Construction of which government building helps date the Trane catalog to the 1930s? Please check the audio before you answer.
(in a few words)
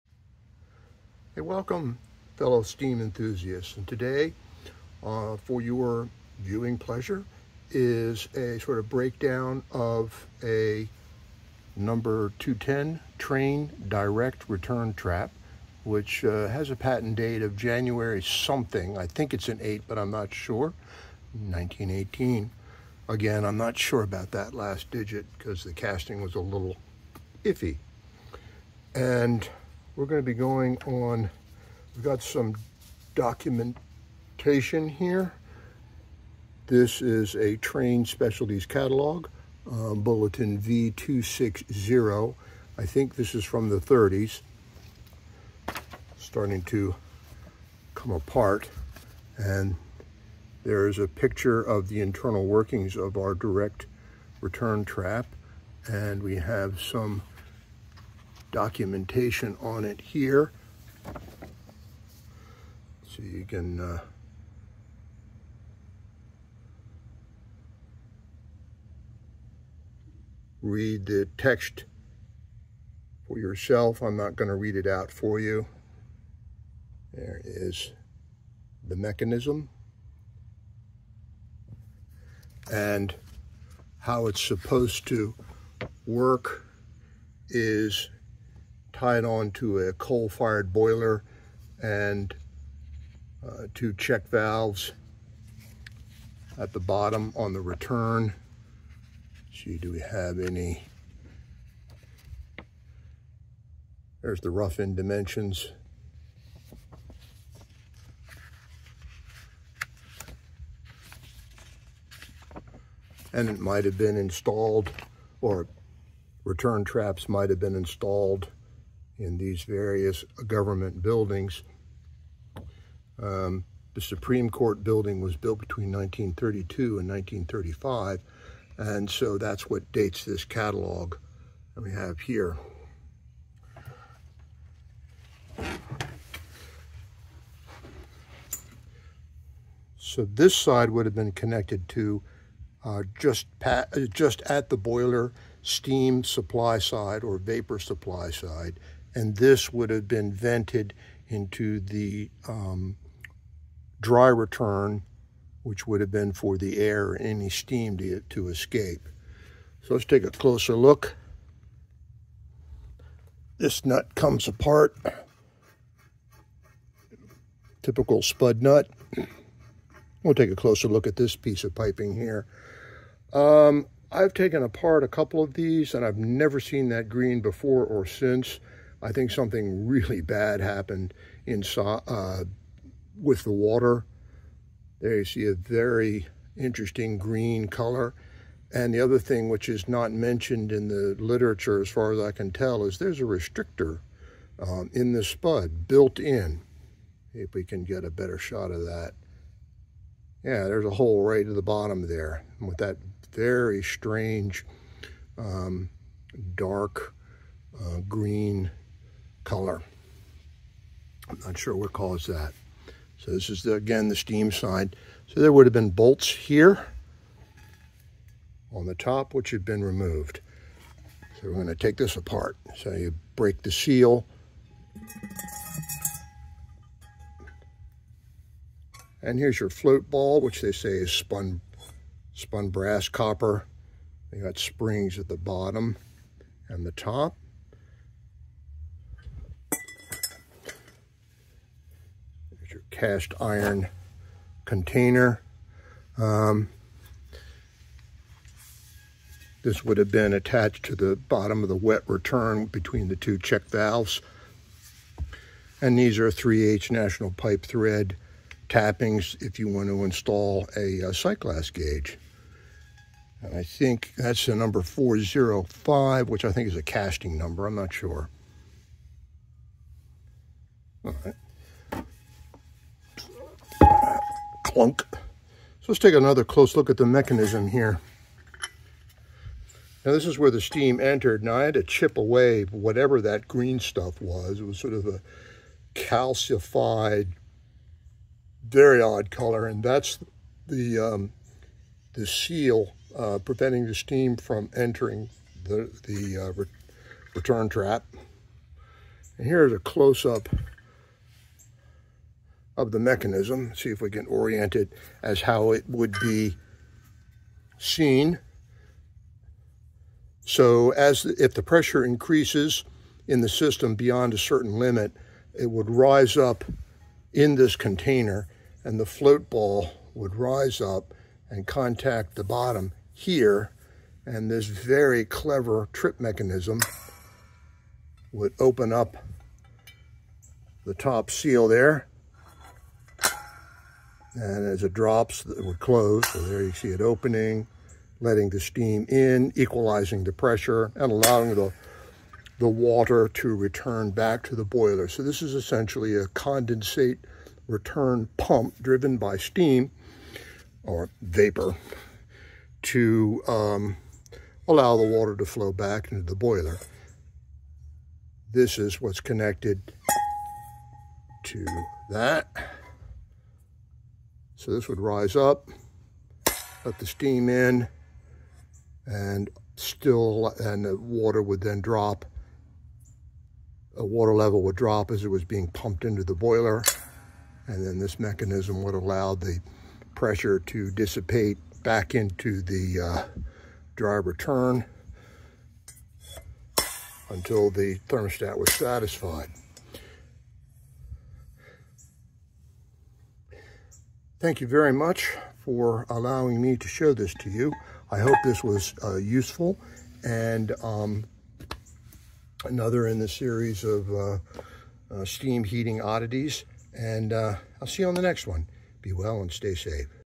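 Supreme Court building.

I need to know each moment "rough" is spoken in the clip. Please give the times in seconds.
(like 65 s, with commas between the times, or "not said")
104 s.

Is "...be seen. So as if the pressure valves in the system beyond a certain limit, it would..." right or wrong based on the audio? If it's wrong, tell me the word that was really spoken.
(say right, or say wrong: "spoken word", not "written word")
wrong: "increases", not "valves".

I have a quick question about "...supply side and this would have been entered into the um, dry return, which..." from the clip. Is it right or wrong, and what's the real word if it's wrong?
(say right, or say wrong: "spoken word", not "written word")
wrong: "vented", not "entered".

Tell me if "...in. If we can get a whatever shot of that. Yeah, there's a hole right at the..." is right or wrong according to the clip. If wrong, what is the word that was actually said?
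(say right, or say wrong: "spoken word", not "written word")
wrong: "better", not "whatever".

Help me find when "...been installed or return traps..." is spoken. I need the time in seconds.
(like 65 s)
113 s.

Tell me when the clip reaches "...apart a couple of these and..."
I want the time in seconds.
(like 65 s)
174 s.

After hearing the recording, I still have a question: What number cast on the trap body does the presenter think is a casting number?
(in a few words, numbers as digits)
405.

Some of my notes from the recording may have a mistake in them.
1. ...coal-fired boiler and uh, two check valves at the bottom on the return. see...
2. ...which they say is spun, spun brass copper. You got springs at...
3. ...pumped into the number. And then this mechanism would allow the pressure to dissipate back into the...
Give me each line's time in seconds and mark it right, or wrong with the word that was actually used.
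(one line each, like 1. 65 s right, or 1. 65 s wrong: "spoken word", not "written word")
1. 89 s right
2. 230 s right
3. 375 s wrong: "boiler", not "number".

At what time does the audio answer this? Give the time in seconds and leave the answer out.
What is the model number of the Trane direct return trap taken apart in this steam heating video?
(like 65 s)
12 s.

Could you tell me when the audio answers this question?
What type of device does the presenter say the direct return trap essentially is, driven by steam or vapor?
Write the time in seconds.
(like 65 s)
346 s.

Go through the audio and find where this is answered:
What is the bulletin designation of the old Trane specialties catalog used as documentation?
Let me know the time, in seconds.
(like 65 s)
40 s.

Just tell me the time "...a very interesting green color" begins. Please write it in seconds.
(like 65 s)
185 s.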